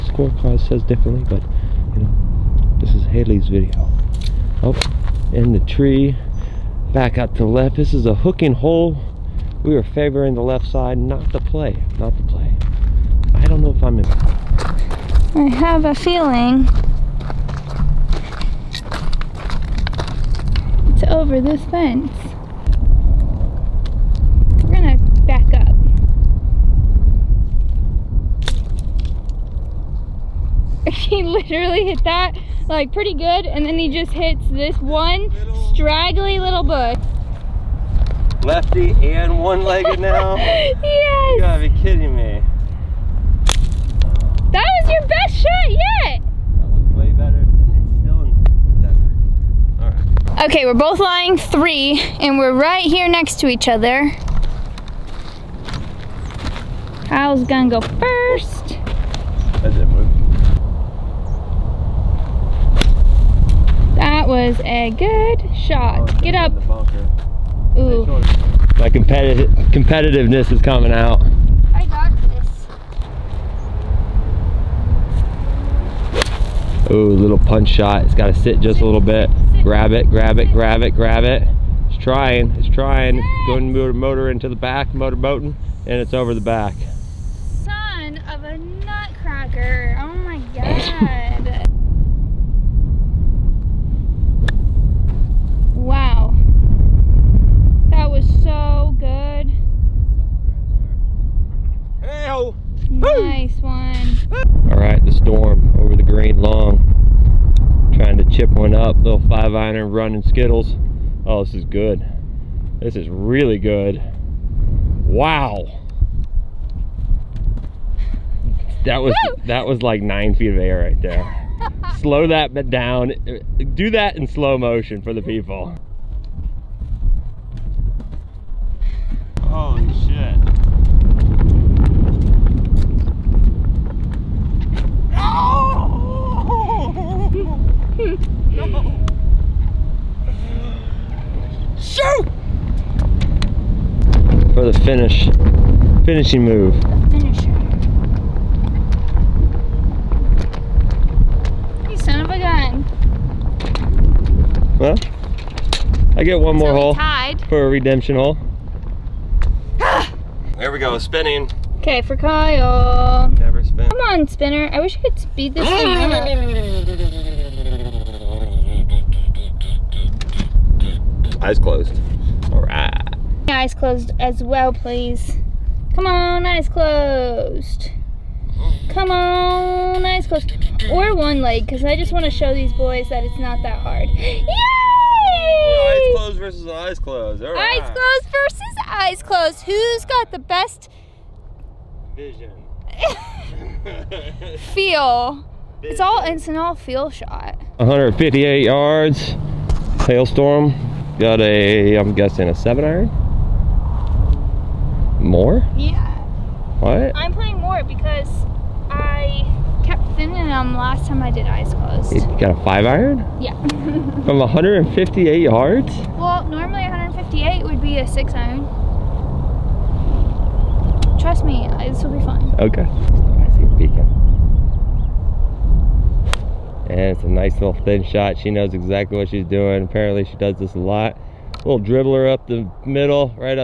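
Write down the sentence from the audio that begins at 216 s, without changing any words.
Well, normally 158 would be a six iron.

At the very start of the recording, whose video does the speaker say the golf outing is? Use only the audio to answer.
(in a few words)
Hailey.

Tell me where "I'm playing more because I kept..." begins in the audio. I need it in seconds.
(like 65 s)
207 s.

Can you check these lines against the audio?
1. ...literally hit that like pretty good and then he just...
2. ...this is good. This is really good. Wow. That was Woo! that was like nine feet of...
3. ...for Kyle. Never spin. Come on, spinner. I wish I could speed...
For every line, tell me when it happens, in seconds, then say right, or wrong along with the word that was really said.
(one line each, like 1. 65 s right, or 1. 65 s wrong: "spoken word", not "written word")
1. 31 s right
2. 111 s right
3. 162 s right.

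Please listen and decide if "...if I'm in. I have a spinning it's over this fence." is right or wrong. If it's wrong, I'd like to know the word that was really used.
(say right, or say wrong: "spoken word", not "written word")
wrong: "feeling", not "spinning".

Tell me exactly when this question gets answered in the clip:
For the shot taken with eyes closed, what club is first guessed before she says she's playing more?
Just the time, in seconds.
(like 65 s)
202 s.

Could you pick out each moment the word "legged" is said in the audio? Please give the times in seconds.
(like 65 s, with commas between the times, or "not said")
39 s.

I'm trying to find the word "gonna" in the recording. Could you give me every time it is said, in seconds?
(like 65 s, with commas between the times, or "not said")
24 s, 57 s.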